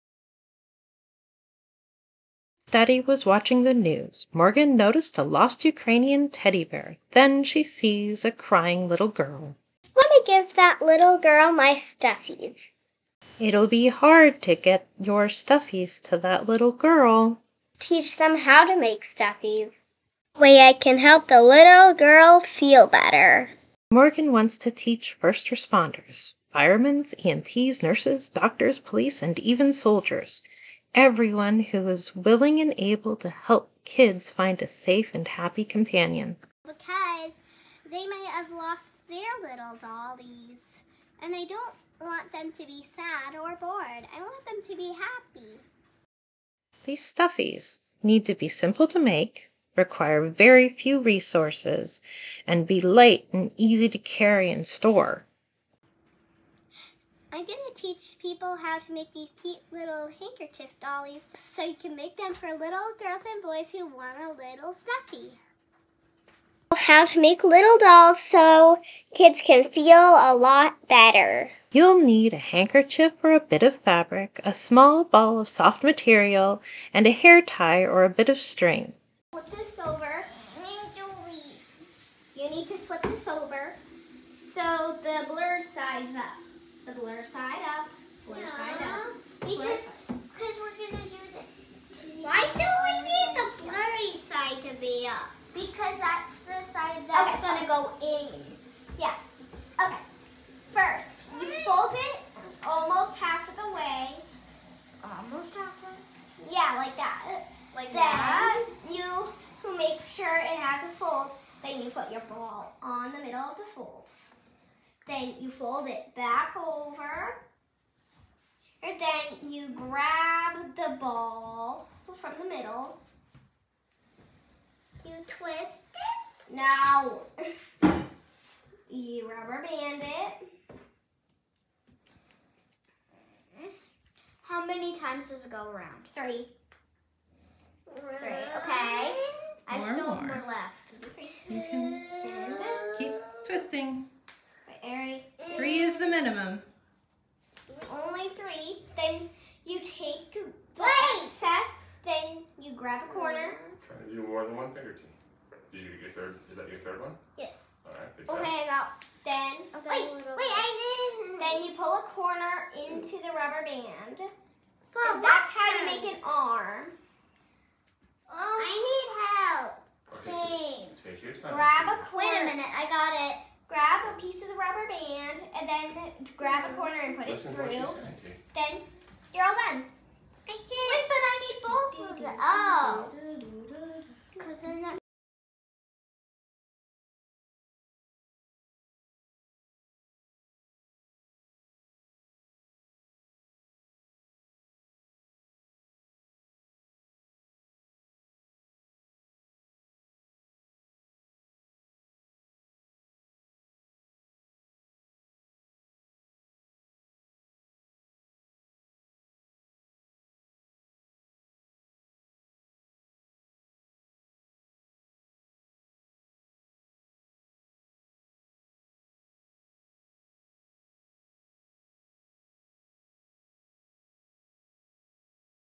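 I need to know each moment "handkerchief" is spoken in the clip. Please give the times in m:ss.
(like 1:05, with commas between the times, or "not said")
1:00, 1:12.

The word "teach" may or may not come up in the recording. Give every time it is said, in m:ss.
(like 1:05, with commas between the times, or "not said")
0:17, 0:24, 0:57.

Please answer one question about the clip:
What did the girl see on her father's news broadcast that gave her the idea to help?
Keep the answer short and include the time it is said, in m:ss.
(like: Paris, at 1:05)
Ukrainian teddy bear, at 0:05.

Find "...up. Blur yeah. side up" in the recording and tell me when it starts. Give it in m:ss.
1:27.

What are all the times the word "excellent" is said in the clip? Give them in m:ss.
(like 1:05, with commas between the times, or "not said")
not said.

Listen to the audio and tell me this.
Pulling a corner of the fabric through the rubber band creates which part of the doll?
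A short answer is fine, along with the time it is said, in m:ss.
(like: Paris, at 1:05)
an arm, at 2:46.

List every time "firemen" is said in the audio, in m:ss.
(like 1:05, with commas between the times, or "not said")
0:26.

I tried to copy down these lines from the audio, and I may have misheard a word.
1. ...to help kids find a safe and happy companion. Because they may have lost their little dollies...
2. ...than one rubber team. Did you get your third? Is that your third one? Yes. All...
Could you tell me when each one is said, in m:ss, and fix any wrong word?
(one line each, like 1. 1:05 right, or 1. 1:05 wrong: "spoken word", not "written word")
1. 0:33 right
2. 2:34 wrong: "finger", not "rubber".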